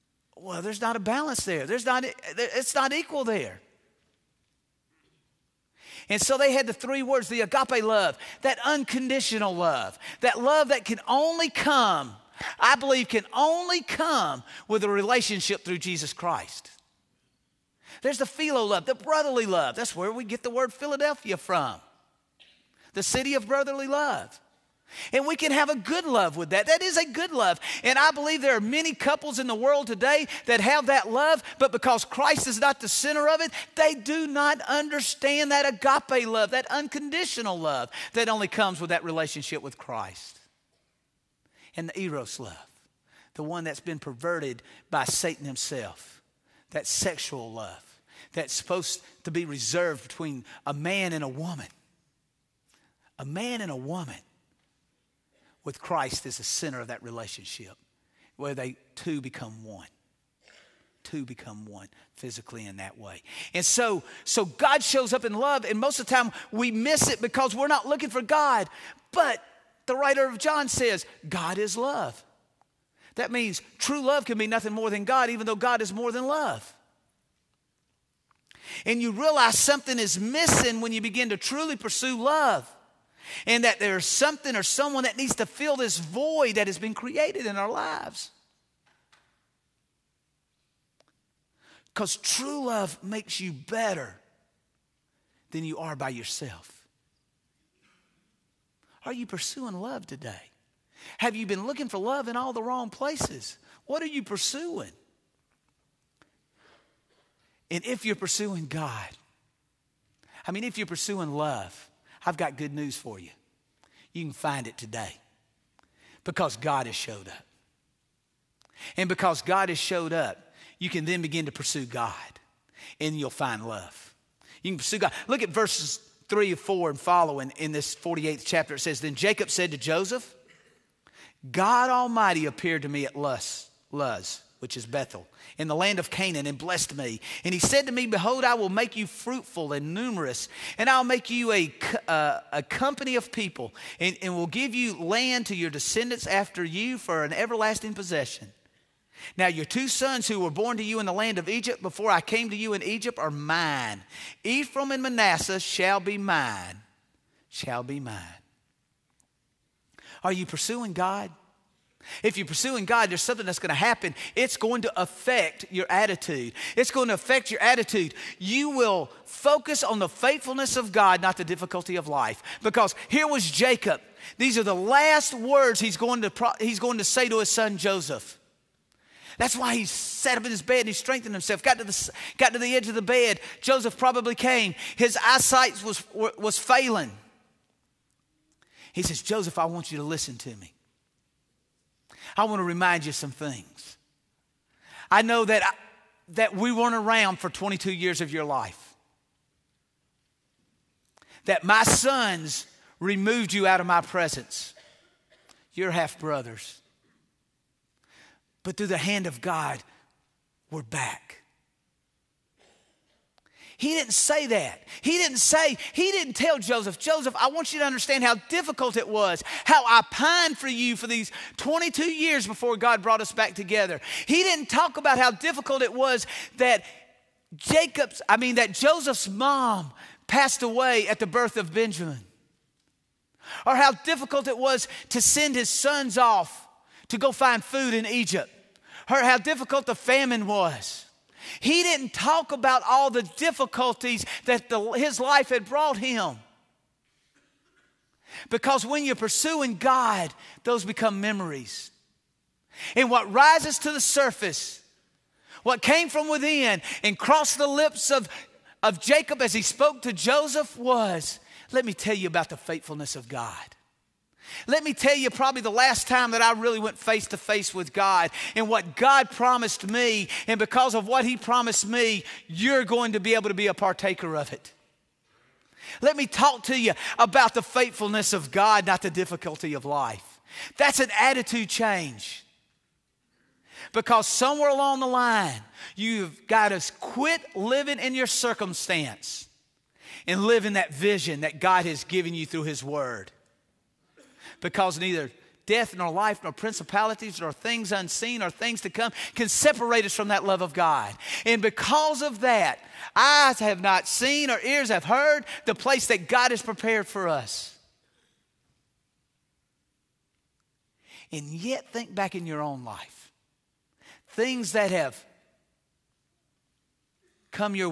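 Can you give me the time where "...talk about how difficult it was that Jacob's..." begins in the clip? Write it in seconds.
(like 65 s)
224 s.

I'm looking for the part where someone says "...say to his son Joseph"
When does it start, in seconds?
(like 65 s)
177 s.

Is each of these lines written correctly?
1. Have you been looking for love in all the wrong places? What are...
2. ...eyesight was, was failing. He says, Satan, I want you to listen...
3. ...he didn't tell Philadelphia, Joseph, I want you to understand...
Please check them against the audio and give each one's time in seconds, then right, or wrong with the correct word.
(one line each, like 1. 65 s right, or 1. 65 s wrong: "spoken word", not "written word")
1. 101 s right
2. 185 s wrong: "Joseph", not "Satan"
3. 215 s wrong: "Joseph", not "Philadelphia".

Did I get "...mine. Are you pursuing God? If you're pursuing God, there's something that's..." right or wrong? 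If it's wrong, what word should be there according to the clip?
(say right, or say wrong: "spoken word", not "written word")
right.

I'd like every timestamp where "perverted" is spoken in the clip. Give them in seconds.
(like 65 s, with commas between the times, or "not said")
43 s.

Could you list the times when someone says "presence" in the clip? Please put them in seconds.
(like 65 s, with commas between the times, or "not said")
204 s.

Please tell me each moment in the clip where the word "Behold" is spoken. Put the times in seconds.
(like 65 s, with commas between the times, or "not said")
138 s.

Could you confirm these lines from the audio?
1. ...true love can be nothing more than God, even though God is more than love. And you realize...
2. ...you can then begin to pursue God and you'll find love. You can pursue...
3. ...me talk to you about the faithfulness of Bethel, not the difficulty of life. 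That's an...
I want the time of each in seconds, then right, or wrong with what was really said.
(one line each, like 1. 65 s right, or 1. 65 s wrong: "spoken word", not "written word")
1. 73 s right
2. 120 s right
3. 276 s wrong: "God", not "Bethel".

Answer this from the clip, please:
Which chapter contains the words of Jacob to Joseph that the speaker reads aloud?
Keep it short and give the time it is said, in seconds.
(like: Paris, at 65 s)
48th, at 127 s.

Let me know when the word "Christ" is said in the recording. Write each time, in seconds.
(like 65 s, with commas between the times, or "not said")
16 s, 32 s, 39 s, 55 s.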